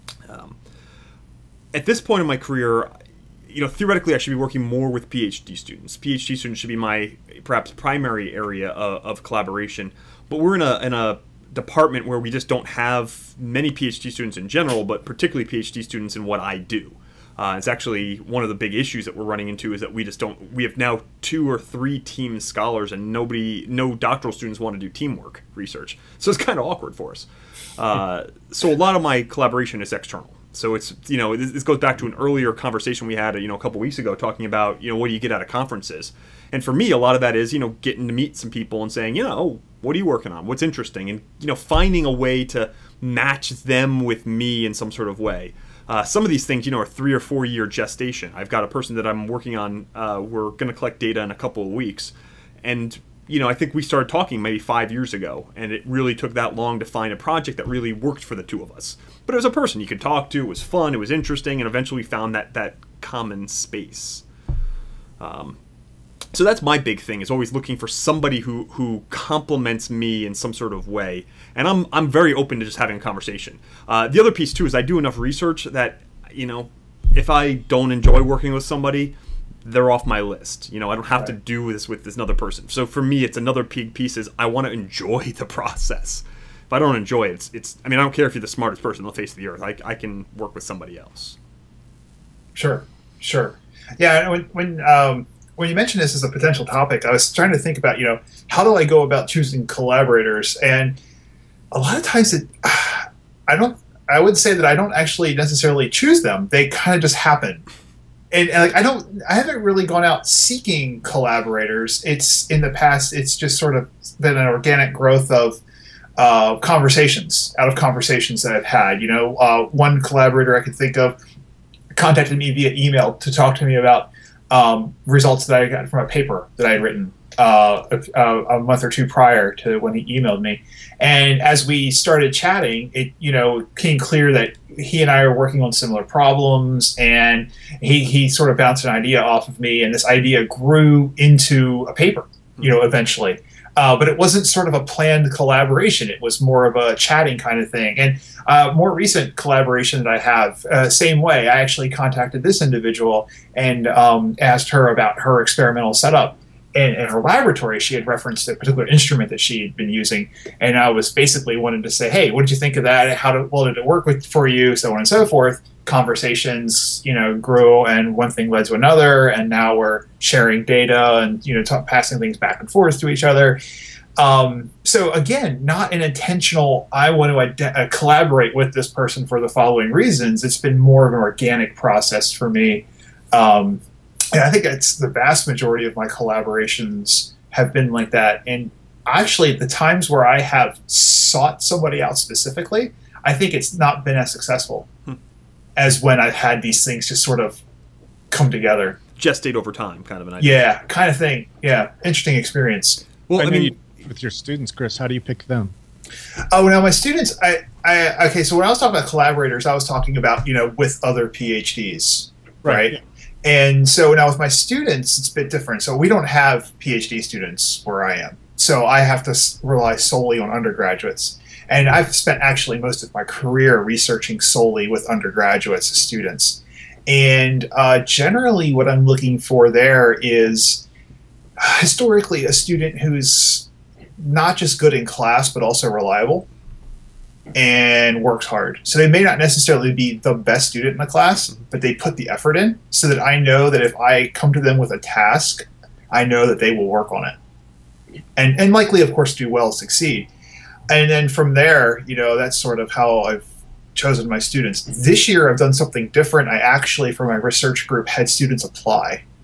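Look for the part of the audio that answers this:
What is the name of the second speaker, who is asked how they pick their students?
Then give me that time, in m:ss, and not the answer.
3:24.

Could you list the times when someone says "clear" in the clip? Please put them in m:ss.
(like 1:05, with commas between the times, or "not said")
2:13.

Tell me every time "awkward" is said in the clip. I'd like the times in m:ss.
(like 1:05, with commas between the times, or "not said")
0:26.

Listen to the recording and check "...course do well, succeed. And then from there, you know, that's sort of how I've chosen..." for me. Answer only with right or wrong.
right.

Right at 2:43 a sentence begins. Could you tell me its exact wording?
How did, well did it work with, for you?" So on and so forth.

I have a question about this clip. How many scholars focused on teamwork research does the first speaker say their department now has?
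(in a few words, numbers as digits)
2 or 3.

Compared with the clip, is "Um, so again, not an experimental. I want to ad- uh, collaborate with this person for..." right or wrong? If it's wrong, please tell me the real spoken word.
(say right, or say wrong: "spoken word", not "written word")
wrong: "intentional", not "experimental".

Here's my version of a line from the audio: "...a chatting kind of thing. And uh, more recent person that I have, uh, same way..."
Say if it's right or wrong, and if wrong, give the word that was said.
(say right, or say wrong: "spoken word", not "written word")
wrong: "collaboration", not "person".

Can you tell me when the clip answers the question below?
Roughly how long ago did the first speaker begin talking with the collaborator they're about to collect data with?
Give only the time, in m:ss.
0:54.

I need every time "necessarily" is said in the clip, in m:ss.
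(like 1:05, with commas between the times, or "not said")
1:45, 3:59.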